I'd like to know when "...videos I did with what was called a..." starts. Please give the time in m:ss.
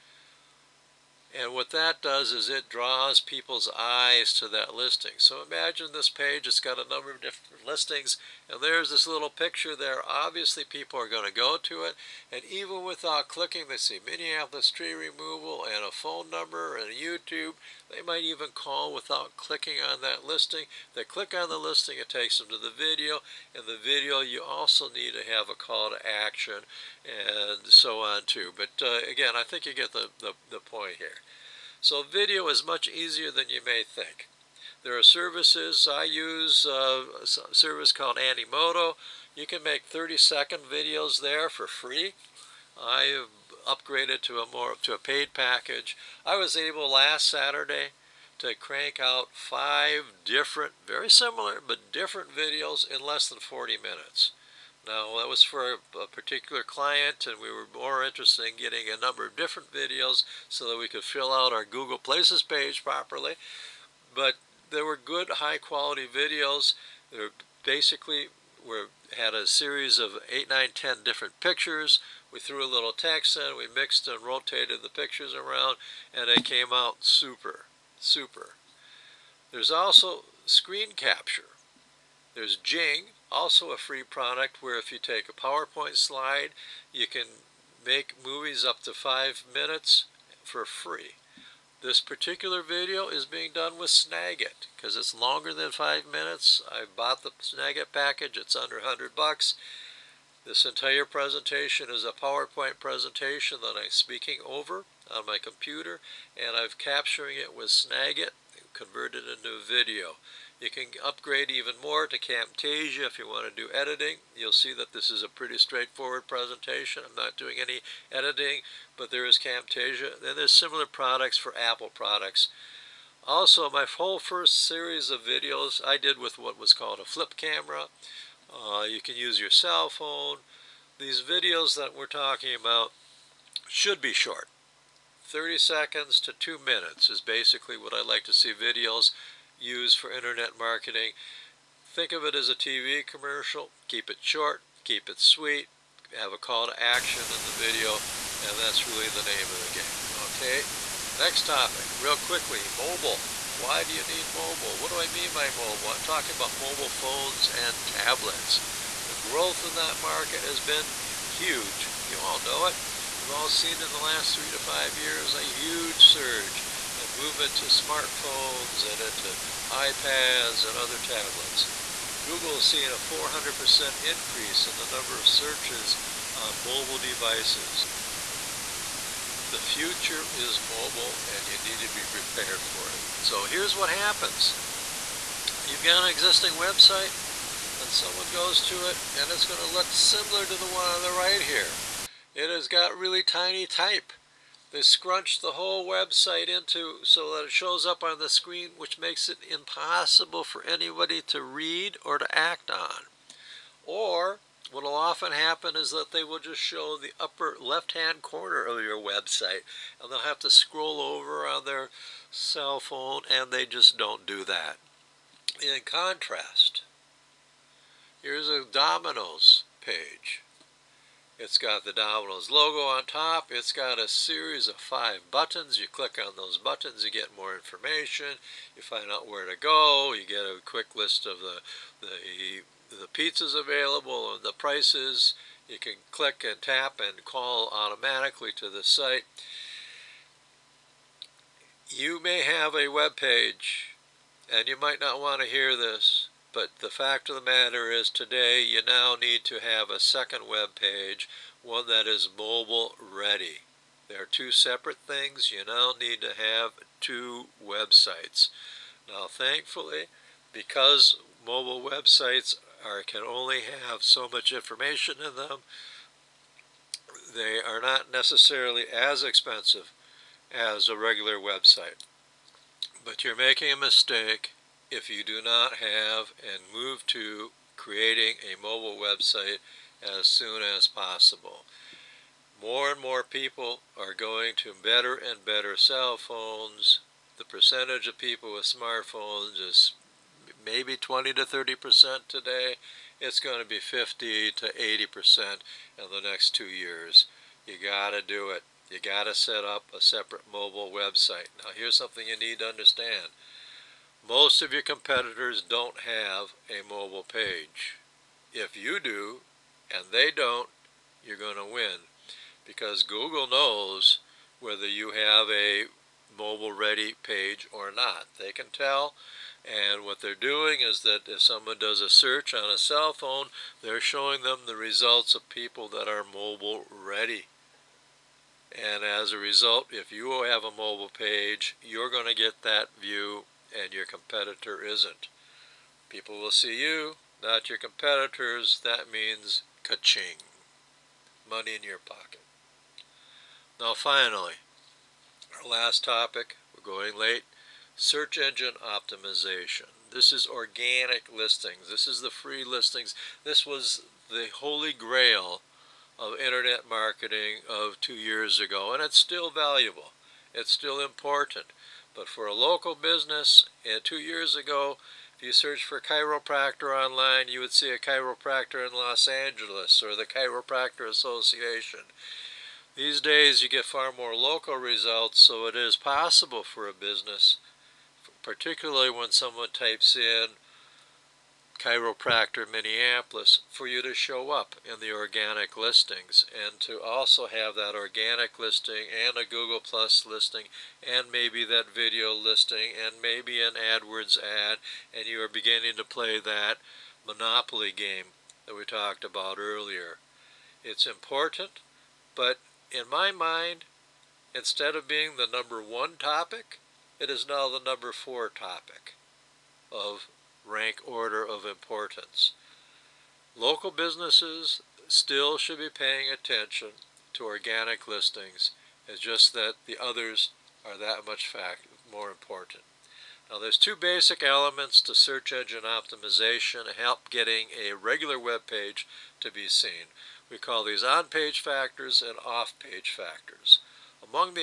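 2:05.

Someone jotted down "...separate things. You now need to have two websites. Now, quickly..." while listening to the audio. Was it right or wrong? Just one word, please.
wrong.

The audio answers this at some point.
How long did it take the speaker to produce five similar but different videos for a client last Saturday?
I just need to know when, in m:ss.
0:53.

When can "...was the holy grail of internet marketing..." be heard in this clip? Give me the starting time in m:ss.
5:53.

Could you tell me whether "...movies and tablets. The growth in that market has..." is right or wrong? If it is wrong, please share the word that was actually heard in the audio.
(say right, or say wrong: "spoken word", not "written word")
wrong: "phones", not "movies".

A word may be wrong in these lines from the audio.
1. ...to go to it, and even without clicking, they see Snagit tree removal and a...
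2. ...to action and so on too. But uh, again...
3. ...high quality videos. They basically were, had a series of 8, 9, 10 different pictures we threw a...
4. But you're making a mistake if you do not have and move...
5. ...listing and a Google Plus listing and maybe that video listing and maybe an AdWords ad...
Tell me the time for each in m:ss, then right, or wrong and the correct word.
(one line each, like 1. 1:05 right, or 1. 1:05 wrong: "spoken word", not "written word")
1. 0:11 wrong: "Minneapolis", not "Snagit"
2. 0:25 right
3. 1:05 right
4. 4:33 right
5. 6:28 right.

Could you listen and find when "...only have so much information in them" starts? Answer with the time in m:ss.
4:23.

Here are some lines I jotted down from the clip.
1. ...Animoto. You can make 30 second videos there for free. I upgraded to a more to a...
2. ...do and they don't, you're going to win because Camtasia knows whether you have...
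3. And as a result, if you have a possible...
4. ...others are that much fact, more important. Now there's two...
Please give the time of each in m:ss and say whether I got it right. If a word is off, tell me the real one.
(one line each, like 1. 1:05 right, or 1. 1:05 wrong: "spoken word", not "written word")
1. 0:38 right
2. 5:09 wrong: "Google", not "Camtasia"
3. 5:28 wrong: "mobile", not "possible"
4. 7:00 right.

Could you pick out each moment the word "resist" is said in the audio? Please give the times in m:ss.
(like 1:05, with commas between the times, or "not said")
not said.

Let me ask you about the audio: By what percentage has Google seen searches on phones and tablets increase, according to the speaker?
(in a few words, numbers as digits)
400%.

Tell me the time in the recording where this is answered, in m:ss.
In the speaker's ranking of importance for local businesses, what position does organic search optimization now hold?
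6:47.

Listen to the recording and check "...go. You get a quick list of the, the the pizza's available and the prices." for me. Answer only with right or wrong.
right.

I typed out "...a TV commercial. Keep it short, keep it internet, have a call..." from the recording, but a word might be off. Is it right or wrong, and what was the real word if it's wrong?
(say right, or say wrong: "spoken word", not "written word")
wrong: "sweet", not "internet".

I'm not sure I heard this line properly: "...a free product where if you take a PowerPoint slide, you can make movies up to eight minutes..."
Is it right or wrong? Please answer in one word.
wrong.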